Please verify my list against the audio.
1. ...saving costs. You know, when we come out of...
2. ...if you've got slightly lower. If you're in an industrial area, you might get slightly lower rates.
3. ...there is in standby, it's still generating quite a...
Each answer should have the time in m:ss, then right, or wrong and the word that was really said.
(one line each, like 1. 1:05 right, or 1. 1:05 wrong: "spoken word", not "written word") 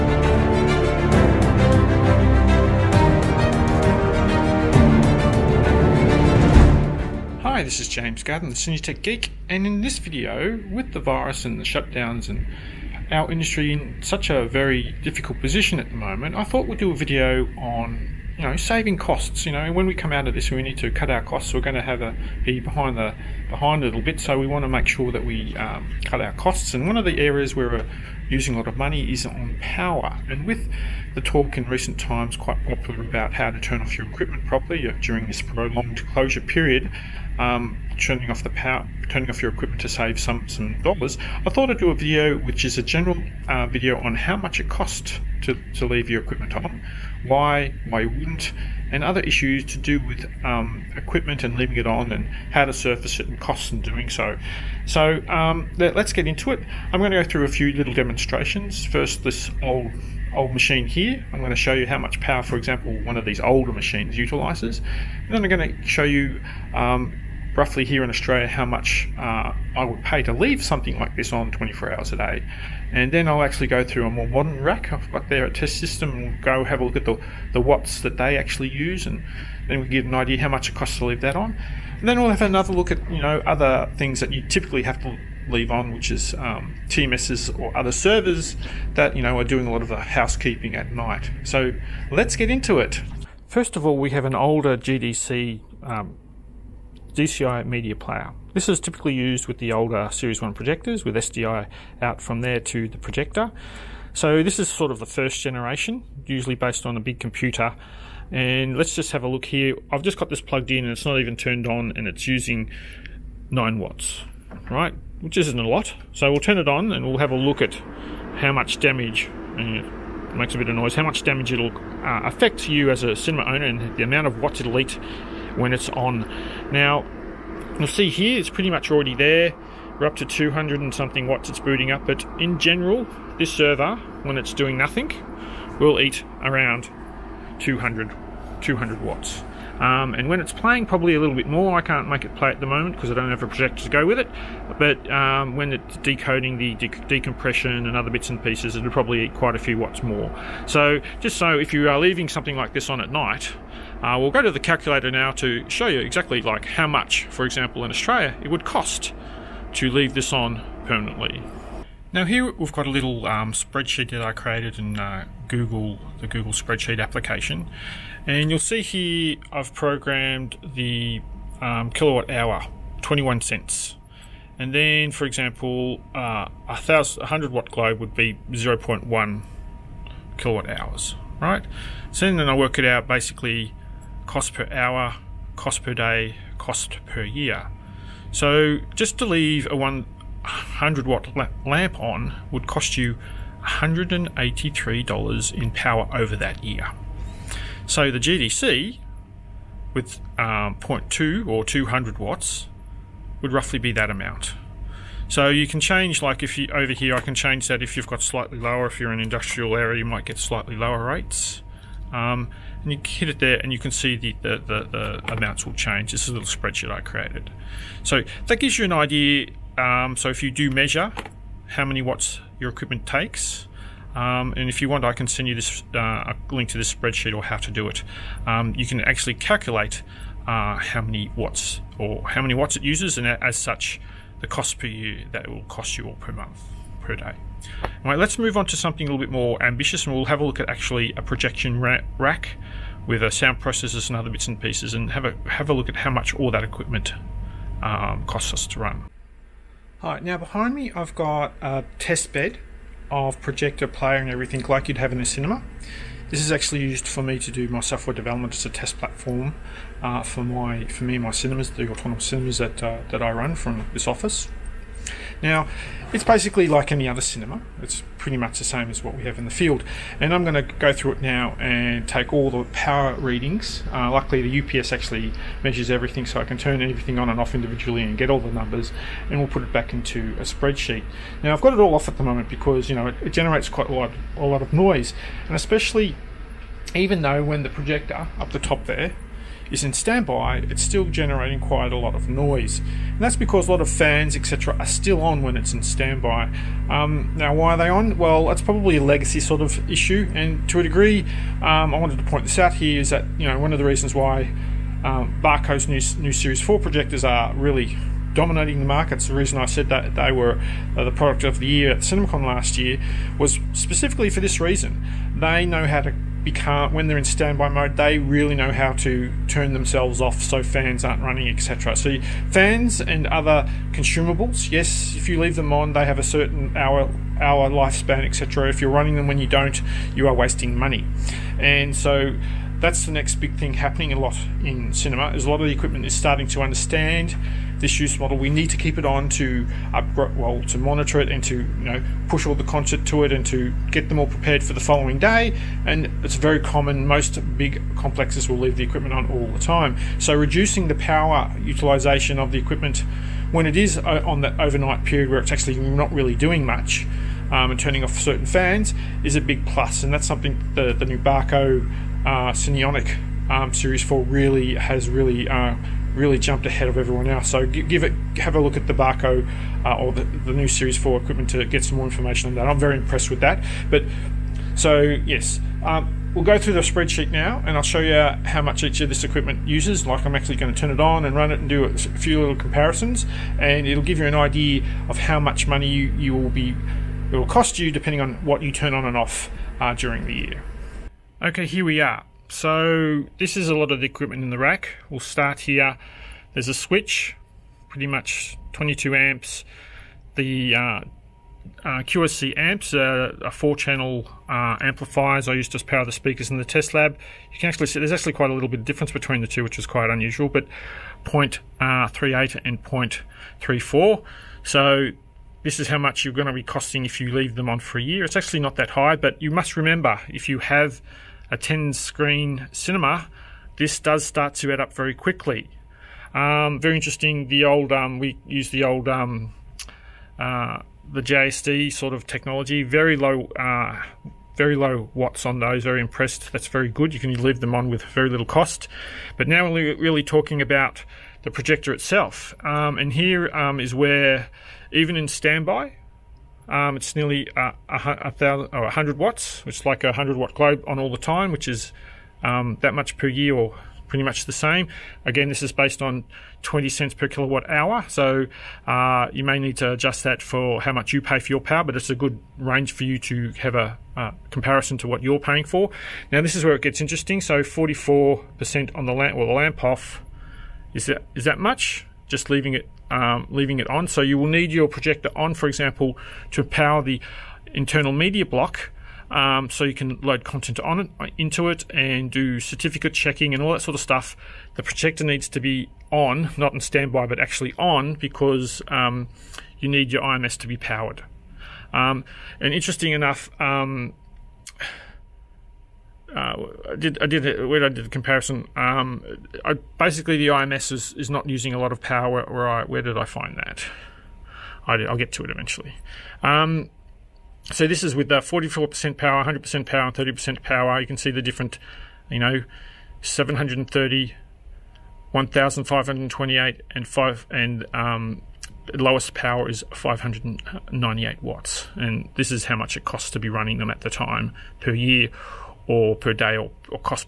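1. 0:18 right
2. 3:27 right
3. 4:48 right.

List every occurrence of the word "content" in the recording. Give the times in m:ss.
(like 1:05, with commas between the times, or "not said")
5:42, 8:00.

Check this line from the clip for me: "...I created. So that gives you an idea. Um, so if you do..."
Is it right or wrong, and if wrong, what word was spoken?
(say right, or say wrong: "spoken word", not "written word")
right.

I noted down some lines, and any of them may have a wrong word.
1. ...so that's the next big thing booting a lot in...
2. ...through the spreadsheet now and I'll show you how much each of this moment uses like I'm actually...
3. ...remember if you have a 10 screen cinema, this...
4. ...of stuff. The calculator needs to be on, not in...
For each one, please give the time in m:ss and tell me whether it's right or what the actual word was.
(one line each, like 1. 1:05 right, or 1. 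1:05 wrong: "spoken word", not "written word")
1. 5:31 wrong: "happening", not "booting"
2. 6:16 wrong: "equipment", not "moment"
3. 6:59 right
4. 8:03 wrong: "projector", not "calculator".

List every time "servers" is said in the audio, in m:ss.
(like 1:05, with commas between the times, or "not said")
1:27, 2:13.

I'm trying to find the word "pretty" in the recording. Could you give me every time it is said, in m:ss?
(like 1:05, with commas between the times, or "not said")
2:08, 4:28, 6:37, 7:34.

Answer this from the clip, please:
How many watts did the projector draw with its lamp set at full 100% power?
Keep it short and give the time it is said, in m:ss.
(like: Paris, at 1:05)
1,528, at 8:35.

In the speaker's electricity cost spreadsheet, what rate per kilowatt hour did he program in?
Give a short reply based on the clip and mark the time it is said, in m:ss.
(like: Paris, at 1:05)
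21 cents, at 2:53.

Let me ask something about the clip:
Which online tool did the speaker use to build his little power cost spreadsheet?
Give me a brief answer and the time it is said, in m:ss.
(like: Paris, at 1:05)
Google spreadsheet, at 2:46.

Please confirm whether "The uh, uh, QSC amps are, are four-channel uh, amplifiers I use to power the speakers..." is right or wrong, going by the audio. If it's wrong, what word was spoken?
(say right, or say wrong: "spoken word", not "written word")
right.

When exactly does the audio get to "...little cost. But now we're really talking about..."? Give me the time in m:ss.
7:18.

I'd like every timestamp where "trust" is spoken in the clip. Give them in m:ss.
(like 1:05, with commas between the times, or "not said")
not said.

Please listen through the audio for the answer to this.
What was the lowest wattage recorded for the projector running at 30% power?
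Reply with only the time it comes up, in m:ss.
8:39.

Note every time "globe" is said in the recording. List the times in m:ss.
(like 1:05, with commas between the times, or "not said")
2:57, 7:30.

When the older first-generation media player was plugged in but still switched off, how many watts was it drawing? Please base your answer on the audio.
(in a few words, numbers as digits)
9 watts.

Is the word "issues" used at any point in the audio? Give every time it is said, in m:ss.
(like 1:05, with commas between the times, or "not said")
0:49, 4:59.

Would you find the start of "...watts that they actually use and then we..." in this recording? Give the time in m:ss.
1:17.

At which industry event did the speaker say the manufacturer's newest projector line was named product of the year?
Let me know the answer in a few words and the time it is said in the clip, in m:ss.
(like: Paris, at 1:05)
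CinemaCon, at 5:11.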